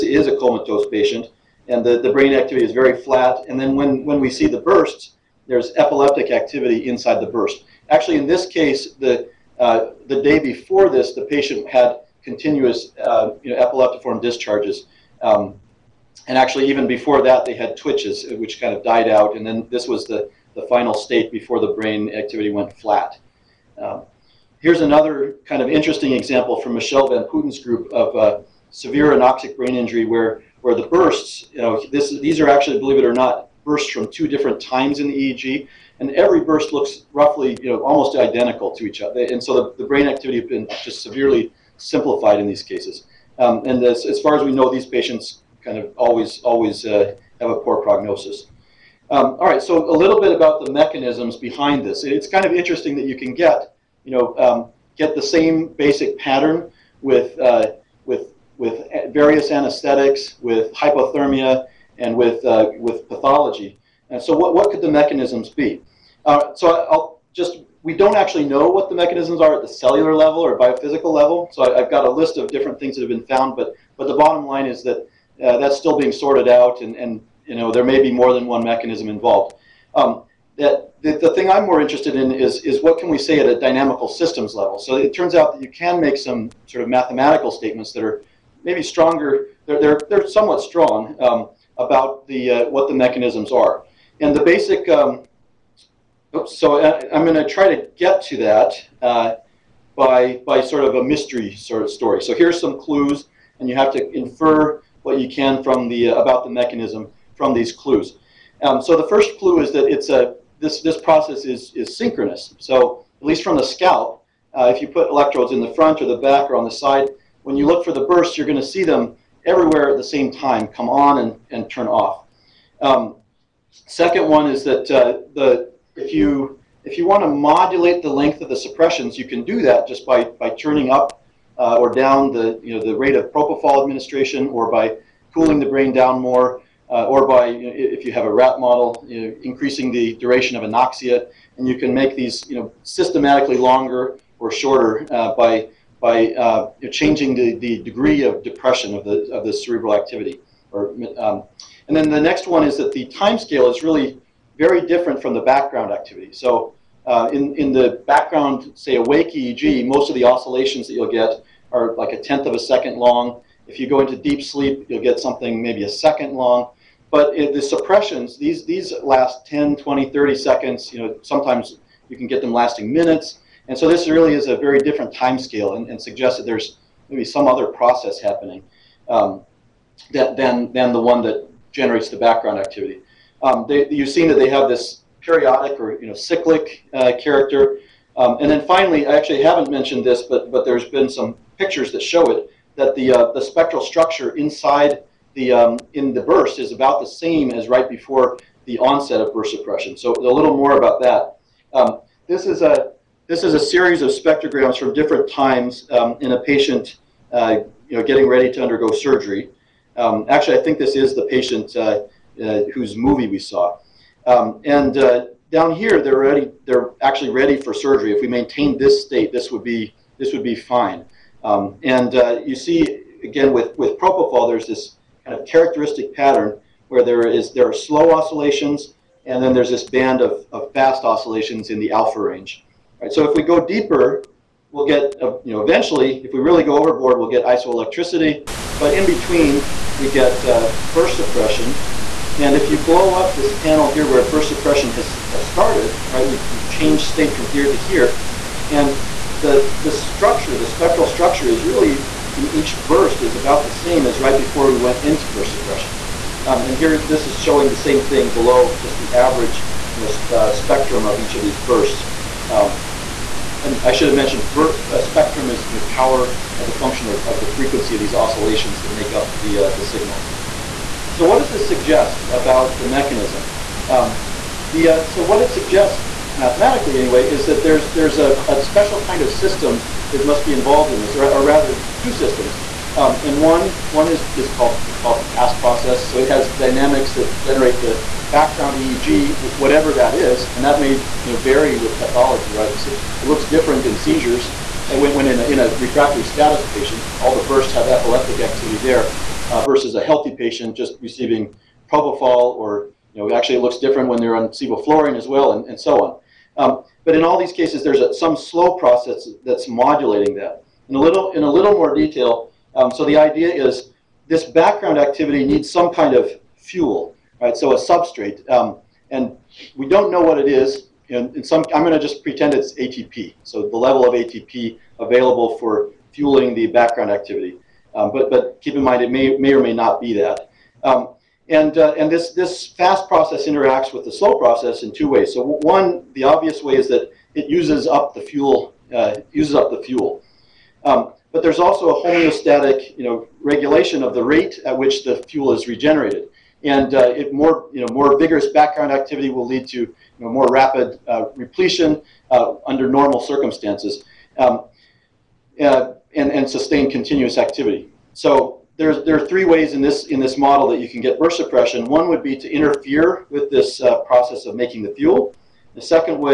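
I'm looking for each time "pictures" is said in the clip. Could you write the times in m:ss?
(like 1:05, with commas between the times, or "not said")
3:11.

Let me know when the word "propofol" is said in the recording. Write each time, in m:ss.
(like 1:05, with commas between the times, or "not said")
2:13, 3:43, 5:01.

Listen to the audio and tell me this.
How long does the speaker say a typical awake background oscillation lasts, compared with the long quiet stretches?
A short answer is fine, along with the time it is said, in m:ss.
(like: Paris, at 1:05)
a tenth of a second, at 2:42.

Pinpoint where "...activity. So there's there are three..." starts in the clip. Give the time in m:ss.
5:57.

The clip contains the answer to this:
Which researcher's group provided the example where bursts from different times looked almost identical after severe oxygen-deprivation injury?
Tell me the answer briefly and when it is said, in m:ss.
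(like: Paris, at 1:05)
Michel Van Putten, at 0:26.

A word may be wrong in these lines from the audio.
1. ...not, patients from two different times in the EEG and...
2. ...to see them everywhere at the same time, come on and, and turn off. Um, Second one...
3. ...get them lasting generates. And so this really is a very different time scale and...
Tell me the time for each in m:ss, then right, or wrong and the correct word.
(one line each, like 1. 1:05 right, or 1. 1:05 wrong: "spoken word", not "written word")
1. 0:33 wrong: "bursts", not "patients"
2. 1:58 right
3. 2:52 wrong: "minutes", not "generates".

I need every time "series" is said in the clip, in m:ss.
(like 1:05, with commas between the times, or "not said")
3:23.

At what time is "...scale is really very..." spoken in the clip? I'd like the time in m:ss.
2:33.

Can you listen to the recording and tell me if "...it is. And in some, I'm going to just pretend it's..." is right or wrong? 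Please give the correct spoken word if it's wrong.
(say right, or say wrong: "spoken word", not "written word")
right.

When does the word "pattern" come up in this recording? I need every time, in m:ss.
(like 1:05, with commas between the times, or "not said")
0:56, 3:46.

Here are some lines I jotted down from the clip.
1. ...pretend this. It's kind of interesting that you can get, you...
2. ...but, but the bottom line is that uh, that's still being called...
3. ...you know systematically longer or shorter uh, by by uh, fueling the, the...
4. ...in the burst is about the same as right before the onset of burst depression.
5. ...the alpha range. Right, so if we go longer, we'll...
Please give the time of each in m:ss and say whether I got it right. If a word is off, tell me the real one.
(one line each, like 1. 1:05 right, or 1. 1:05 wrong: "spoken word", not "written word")
1. 0:51 wrong: "behind", not "pretend"
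2. 1:13 wrong: "sorted", not "called"
3. 2:22 wrong: "changing", not "fueling"
4. 3:15 wrong: "suppression", not "depression"
5. 3:51 wrong: "deeper", not "longer".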